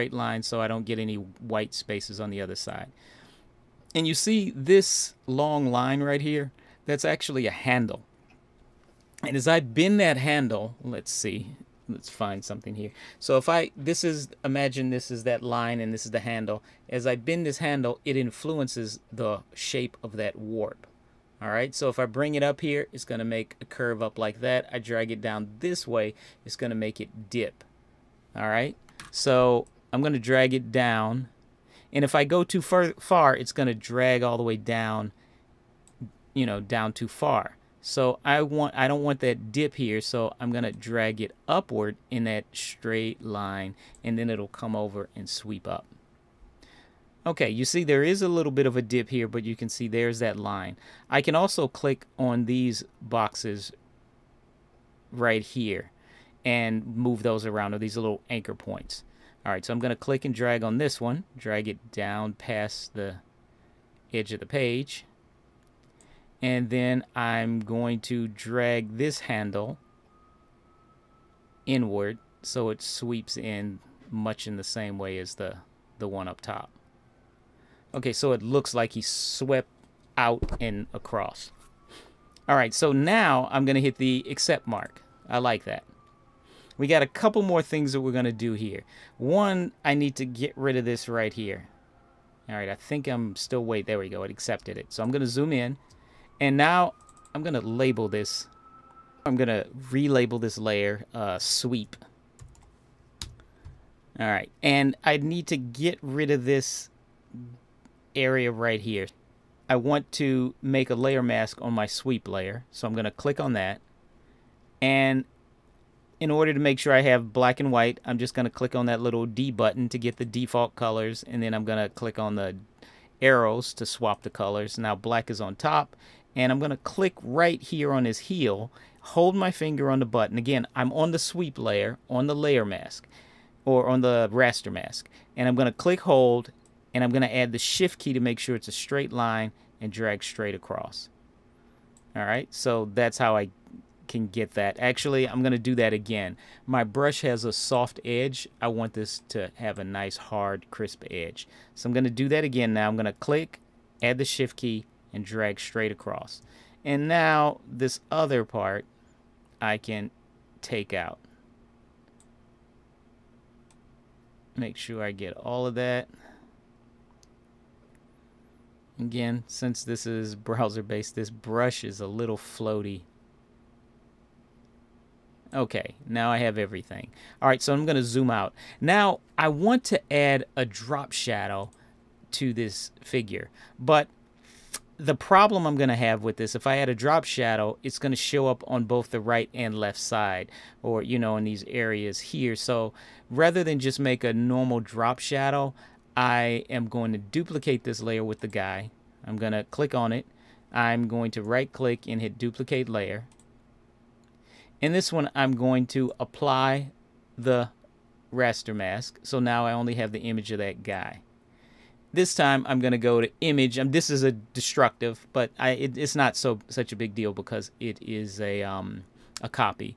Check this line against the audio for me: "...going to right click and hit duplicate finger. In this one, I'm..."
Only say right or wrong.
wrong.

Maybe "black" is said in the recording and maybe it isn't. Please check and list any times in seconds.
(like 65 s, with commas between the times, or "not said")
117 s, 124 s.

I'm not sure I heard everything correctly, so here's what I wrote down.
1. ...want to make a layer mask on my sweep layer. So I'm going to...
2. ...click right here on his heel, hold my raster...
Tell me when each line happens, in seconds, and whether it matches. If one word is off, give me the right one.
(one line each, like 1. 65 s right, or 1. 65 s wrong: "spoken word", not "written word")
1. 109 s right
2. 126 s wrong: "finger", not "raster".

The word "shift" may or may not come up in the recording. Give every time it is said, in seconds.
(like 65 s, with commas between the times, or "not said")
137 s, 154 s.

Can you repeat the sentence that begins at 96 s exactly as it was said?
And now I'm going to label this.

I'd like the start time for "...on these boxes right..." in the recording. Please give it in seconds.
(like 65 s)
52 s.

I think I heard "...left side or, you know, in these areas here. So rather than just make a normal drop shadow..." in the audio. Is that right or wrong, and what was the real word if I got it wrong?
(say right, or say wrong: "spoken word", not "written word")
right.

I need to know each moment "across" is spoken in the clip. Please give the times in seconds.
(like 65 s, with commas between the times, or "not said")
80 s, 140 s, 155 s.